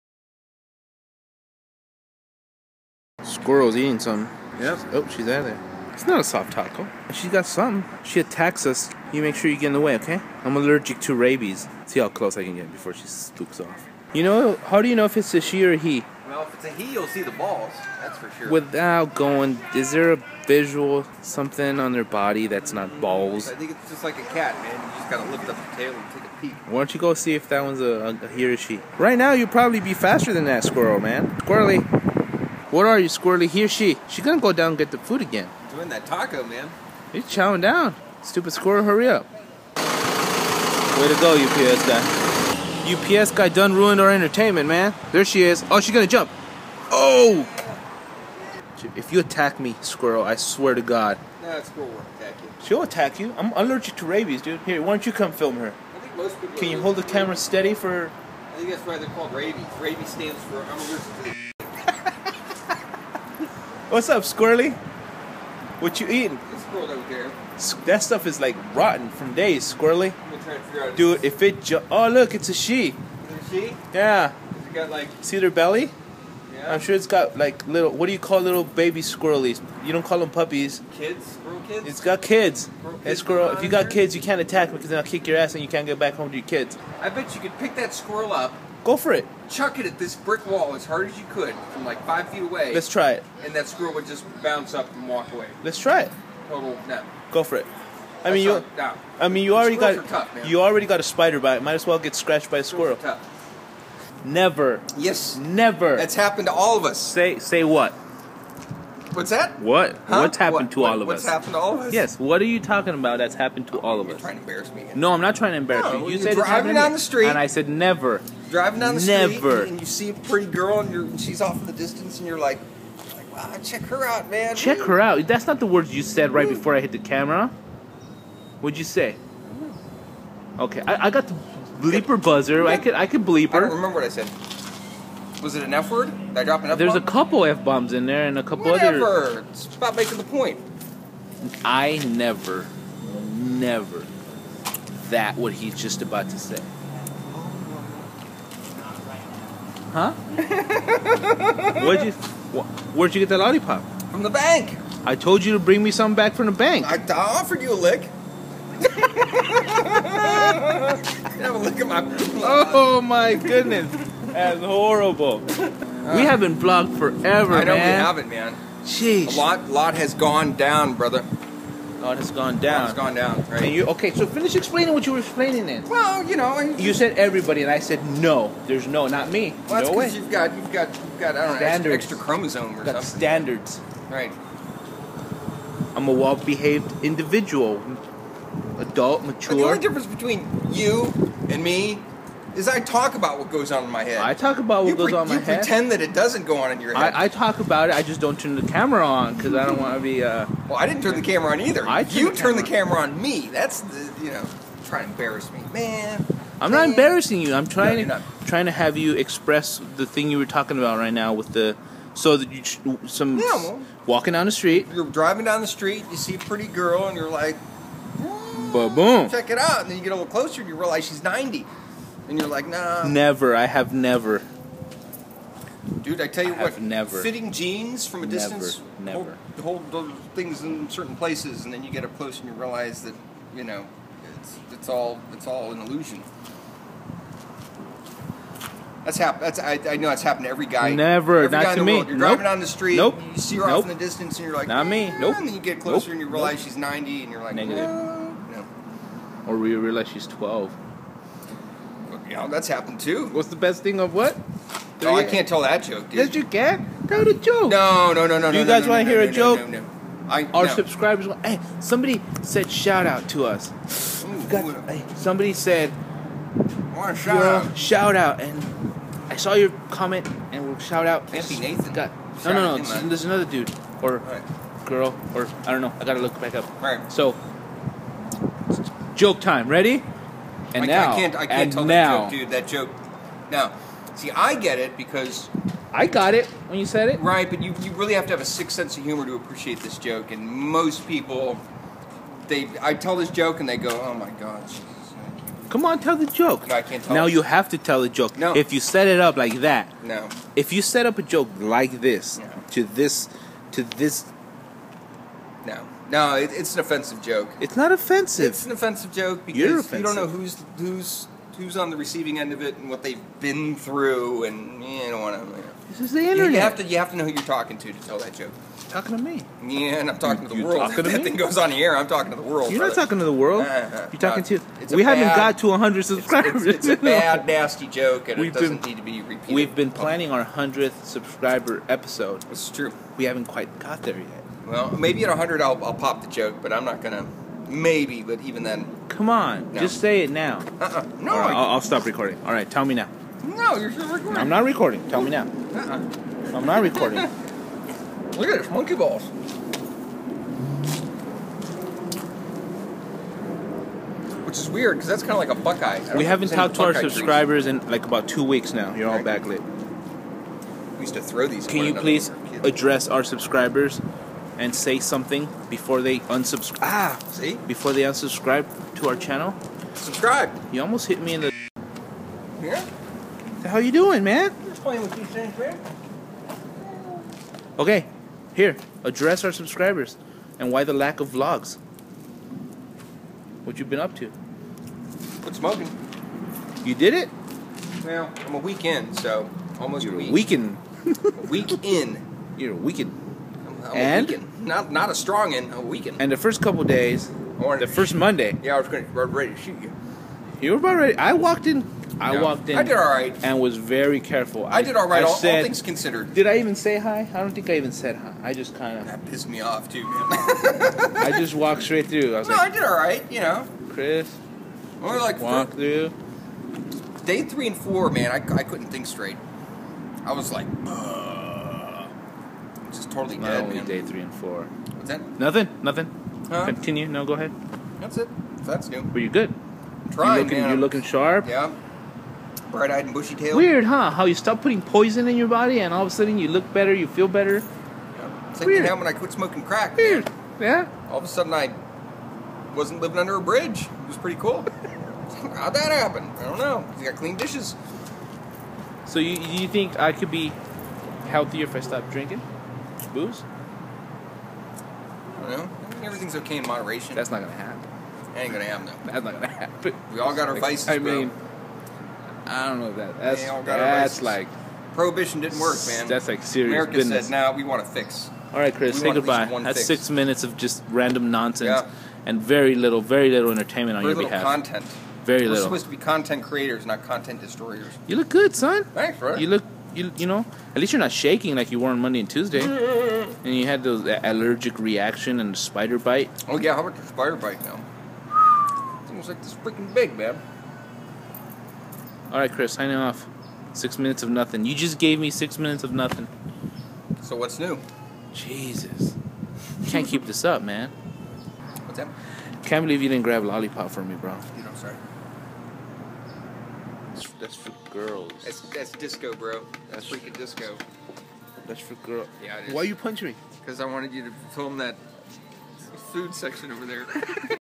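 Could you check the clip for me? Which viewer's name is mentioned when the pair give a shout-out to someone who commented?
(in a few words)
Nancy Nathan.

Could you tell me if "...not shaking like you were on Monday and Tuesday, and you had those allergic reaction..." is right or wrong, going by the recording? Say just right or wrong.
right.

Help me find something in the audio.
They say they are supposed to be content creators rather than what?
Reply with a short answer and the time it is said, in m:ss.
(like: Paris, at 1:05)
content destroyers, at 7:57.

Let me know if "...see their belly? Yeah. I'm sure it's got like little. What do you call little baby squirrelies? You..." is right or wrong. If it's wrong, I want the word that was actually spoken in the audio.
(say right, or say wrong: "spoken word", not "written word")
right.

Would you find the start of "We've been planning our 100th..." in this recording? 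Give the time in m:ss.
5:29.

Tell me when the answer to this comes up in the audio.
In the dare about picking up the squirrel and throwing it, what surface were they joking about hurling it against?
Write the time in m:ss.
1:30.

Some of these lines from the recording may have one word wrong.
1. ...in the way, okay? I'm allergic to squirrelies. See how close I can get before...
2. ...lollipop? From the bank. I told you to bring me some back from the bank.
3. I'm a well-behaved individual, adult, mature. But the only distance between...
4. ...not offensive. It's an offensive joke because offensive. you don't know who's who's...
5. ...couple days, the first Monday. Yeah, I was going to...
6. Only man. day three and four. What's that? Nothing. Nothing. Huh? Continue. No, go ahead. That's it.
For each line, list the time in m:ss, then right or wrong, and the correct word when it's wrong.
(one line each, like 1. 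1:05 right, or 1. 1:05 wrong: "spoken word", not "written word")
1. 0:09 wrong: "rabies", not "squirrelies"
2. 2:33 right
3. 3:05 wrong: "difference", not "distance"
4. 5:07 right
5. 6:36 right
6. 7:03 right.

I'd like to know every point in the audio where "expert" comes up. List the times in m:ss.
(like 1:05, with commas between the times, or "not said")
not said.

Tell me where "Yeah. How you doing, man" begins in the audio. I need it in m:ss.
6:12.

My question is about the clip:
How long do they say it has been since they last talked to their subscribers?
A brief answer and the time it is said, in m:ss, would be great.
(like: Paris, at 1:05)
about two weeks, at 5:58.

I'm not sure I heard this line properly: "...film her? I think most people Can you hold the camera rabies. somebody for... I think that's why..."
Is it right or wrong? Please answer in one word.
wrong.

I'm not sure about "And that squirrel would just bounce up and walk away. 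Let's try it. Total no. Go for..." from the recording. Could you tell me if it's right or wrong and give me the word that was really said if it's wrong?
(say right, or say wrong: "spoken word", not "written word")
right.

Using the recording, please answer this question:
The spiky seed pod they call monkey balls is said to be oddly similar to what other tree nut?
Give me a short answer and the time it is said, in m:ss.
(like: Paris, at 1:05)
Buckeye, at 5:55.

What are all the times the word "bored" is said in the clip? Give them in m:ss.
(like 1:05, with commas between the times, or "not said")
not said.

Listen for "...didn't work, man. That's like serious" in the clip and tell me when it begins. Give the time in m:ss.
7:45.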